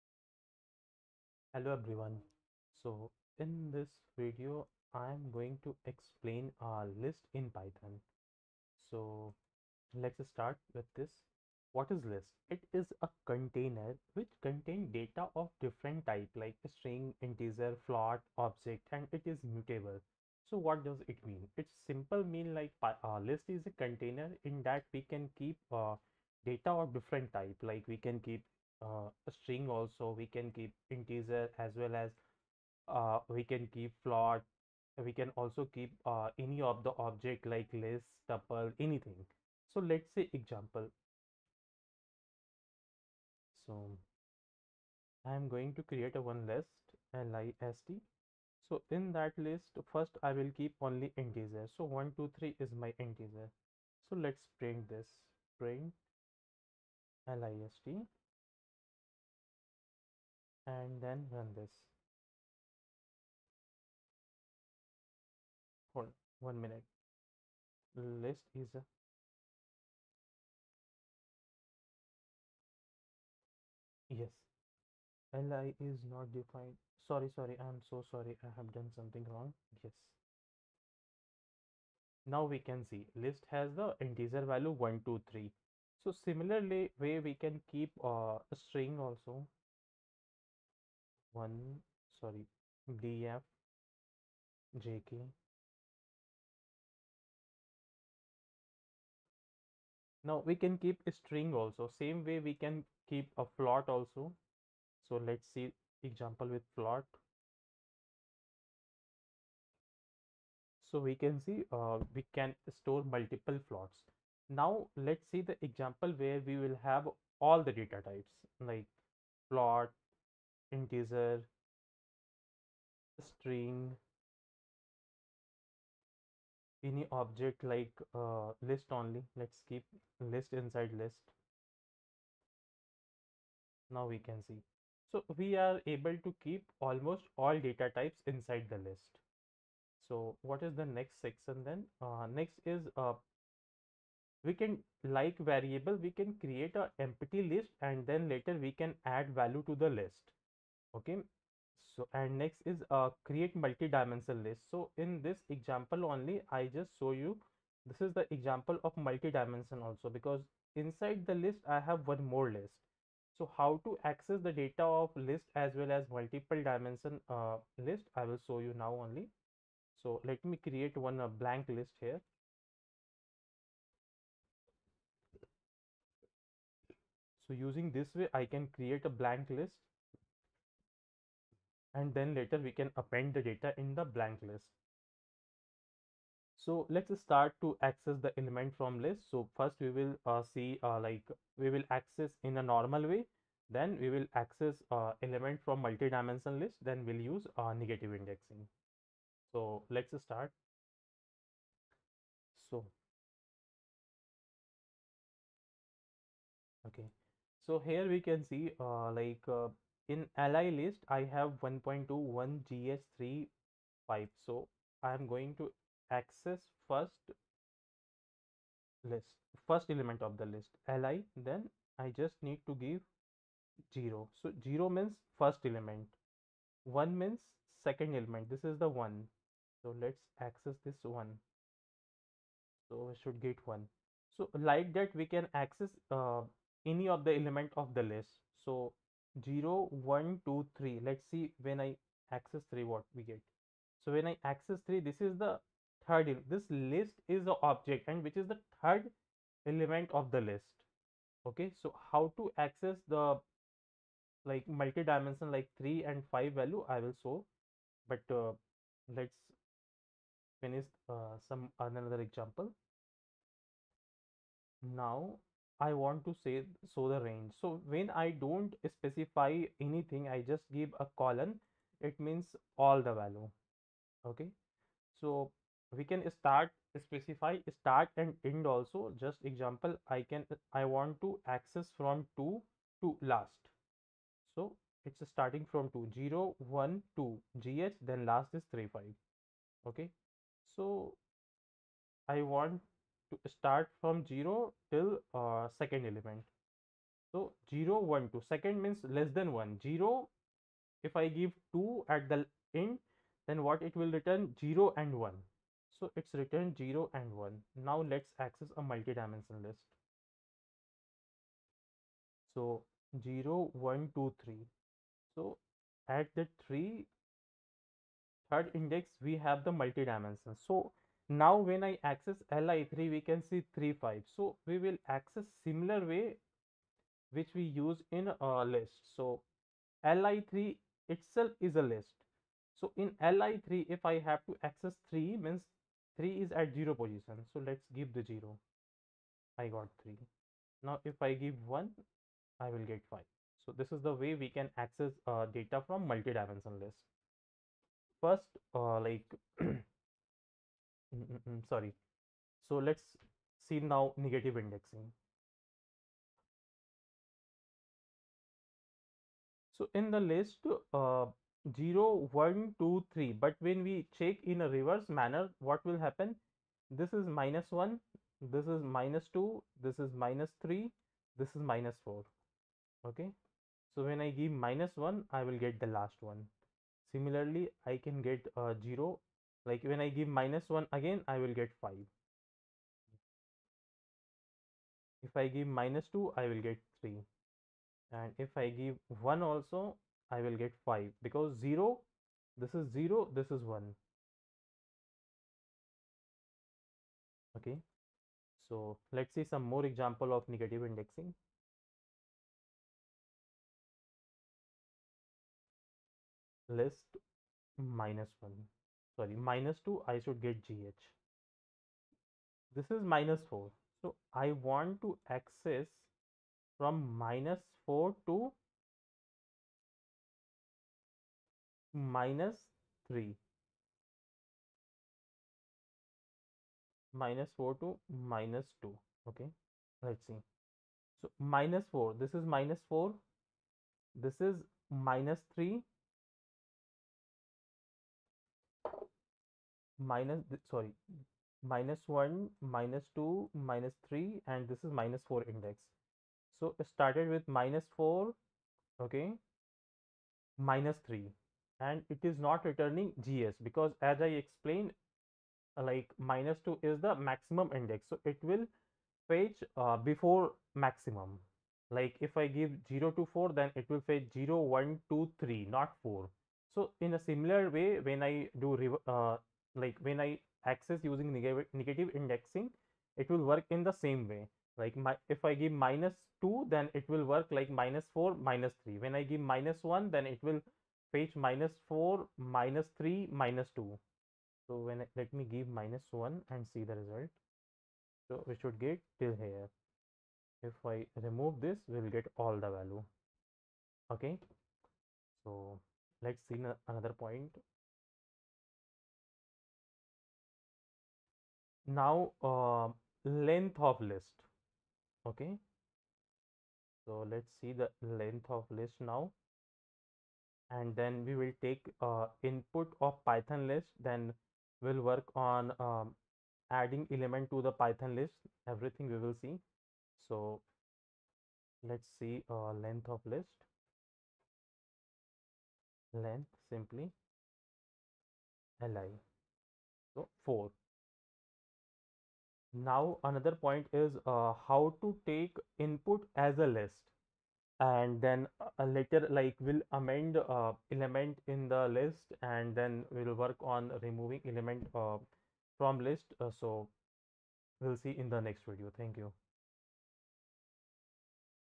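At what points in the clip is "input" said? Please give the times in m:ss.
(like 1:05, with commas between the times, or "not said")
8:32, 8:55.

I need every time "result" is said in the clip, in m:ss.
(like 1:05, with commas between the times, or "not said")
8:06.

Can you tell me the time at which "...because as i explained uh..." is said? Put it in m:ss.
7:33.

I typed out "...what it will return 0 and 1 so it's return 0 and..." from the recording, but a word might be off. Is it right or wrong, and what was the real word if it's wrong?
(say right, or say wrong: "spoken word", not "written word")
right.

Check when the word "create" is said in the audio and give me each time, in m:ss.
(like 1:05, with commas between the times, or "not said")
0:45, 2:26, 2:33, 2:50, 2:58.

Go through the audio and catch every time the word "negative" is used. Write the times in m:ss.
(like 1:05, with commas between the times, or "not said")
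3:17, 5:54, 6:40, 7:51.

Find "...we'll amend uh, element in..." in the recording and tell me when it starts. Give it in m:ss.
8:59.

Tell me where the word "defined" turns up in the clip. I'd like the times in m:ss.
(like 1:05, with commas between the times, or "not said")
1:16.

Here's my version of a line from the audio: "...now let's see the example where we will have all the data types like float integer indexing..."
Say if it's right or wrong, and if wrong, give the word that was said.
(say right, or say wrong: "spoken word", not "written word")
wrong: "string", not "indexing".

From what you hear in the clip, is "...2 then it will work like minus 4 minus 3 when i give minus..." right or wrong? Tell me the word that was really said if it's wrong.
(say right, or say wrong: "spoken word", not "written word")
right.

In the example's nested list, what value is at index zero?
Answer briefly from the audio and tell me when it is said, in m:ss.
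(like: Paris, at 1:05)
3, at 5:36.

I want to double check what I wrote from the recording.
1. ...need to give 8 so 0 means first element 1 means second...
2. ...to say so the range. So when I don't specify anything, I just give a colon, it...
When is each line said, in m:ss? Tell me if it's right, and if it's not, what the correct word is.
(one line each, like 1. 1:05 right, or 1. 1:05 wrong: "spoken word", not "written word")
1. 3:42 wrong: "0", not "8"
2. 4:26 right.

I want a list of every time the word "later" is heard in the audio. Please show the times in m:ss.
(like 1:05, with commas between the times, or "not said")
2:28, 3:02, 8:58.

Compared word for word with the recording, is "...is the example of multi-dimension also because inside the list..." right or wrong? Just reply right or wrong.
right.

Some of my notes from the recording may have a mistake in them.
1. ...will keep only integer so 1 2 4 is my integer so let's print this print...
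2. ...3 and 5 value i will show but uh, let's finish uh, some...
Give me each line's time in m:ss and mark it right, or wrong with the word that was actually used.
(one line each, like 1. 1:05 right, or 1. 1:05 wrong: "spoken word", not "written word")
1. 0:50 wrong: "3", not "4"
2. 4:15 right.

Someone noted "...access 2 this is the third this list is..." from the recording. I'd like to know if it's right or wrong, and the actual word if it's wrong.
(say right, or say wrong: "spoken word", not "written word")
wrong: "3", not "2".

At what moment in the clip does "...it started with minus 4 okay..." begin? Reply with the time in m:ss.
7:26.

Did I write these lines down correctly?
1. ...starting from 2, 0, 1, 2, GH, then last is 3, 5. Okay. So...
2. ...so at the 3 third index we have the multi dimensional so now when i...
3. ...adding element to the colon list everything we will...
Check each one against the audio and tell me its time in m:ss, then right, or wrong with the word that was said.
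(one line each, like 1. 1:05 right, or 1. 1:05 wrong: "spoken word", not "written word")
1. 4:45 right
2. 5:15 right
3. 8:36 wrong: "python", not "colon".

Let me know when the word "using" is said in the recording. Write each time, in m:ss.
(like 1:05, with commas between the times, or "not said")
2:57, 7:51.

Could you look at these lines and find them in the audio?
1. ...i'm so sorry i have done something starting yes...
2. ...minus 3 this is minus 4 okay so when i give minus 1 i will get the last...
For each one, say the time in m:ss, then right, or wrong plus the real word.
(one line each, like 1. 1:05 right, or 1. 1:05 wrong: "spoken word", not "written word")
1. 1:17 wrong: "wrong", not "starting"
2. 6:10 right.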